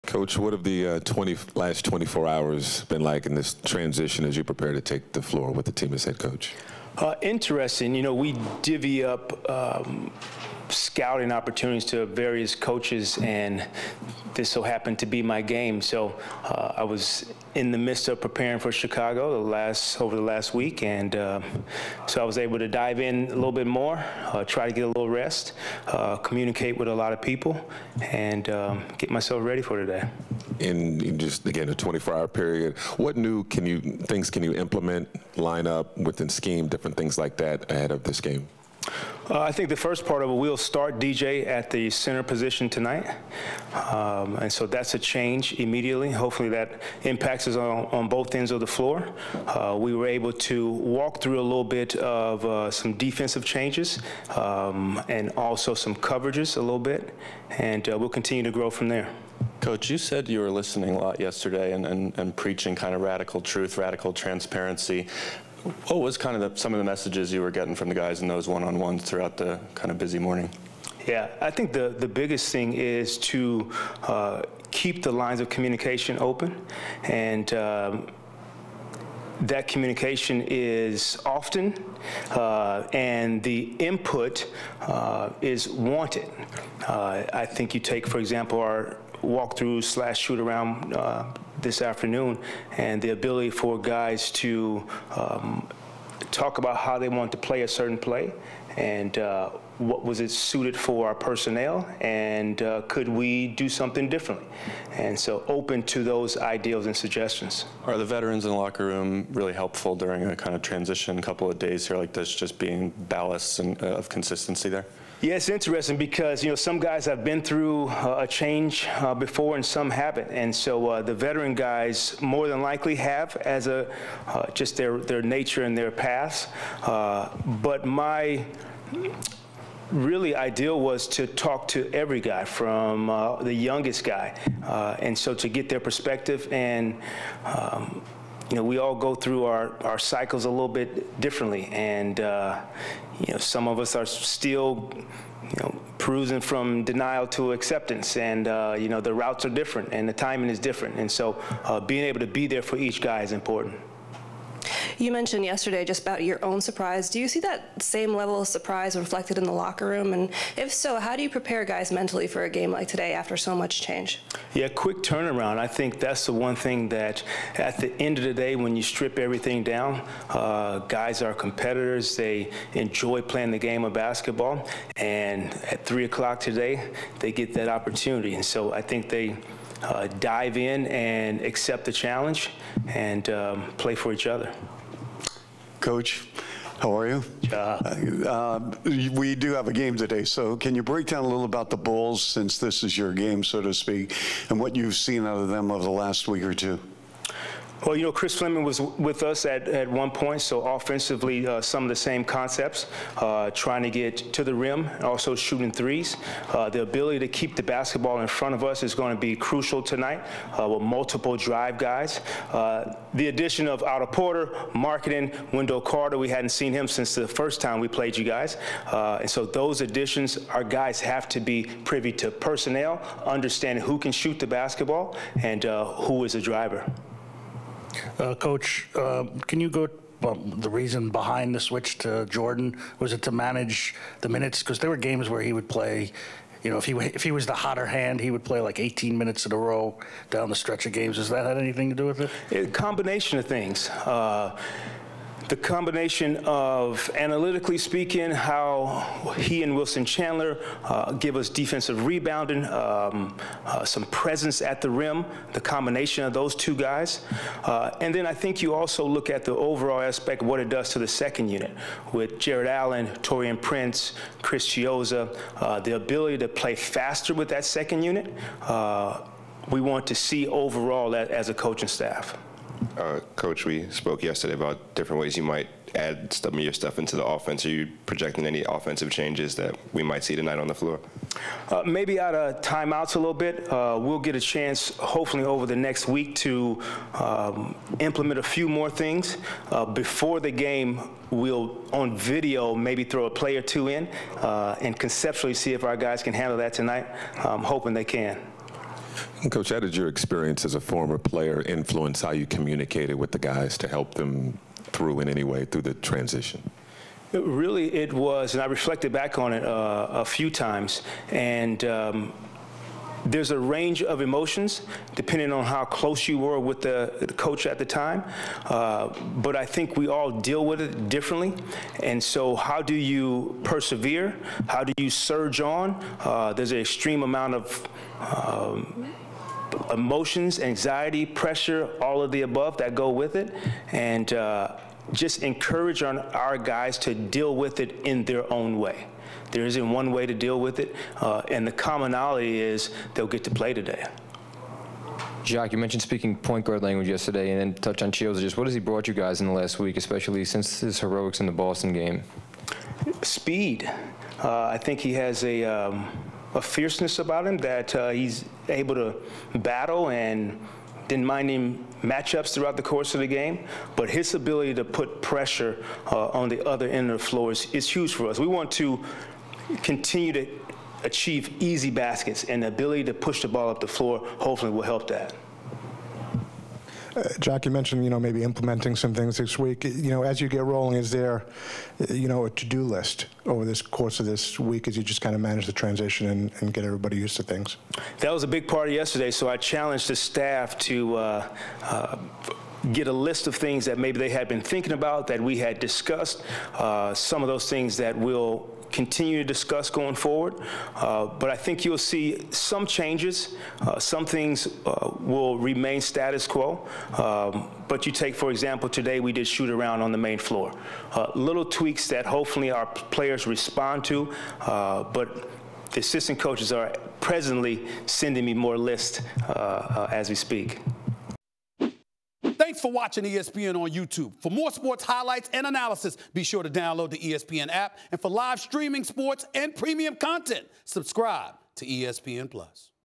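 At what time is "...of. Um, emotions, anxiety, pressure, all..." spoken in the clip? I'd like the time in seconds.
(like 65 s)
327 s.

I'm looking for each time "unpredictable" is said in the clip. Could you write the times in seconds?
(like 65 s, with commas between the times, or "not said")
not said.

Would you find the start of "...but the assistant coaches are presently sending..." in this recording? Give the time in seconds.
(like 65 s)
415 s.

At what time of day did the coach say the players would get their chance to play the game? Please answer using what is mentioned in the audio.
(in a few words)
3 o'clock.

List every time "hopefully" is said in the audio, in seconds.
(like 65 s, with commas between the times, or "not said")
46 s, 284 s, 374 s, 412 s.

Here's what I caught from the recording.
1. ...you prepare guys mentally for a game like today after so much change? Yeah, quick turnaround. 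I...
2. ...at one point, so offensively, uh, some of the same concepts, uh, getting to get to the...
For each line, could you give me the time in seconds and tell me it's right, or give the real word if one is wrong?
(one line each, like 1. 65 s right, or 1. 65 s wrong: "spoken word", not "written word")
1. 161 s right
2. 199 s wrong: "trying", not "getting".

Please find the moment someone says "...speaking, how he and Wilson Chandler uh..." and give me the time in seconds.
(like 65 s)
247 s.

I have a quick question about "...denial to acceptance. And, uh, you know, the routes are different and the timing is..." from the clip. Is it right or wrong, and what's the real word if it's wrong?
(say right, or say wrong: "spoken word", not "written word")
right.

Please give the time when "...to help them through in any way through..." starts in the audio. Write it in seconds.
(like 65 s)
303 s.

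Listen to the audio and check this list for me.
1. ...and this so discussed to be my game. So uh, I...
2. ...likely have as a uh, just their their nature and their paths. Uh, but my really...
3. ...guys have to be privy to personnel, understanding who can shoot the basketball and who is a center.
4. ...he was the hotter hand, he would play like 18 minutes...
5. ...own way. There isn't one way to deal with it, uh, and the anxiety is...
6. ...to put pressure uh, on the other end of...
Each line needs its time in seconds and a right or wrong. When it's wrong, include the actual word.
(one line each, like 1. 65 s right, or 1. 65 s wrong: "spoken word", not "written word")
1. 13 s wrong: "happened", not "discussed"
2. 122 s right
3. 220 s wrong: "driver", not "center"
4. 237 s right
5. 338 s wrong: "commonality", not "anxiety"
6. 364 s right.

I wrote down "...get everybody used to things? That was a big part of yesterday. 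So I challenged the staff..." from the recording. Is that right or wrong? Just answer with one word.
right.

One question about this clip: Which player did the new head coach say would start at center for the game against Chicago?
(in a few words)
DJ.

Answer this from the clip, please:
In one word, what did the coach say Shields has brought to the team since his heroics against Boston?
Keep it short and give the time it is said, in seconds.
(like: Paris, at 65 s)
Speed, at 353 s.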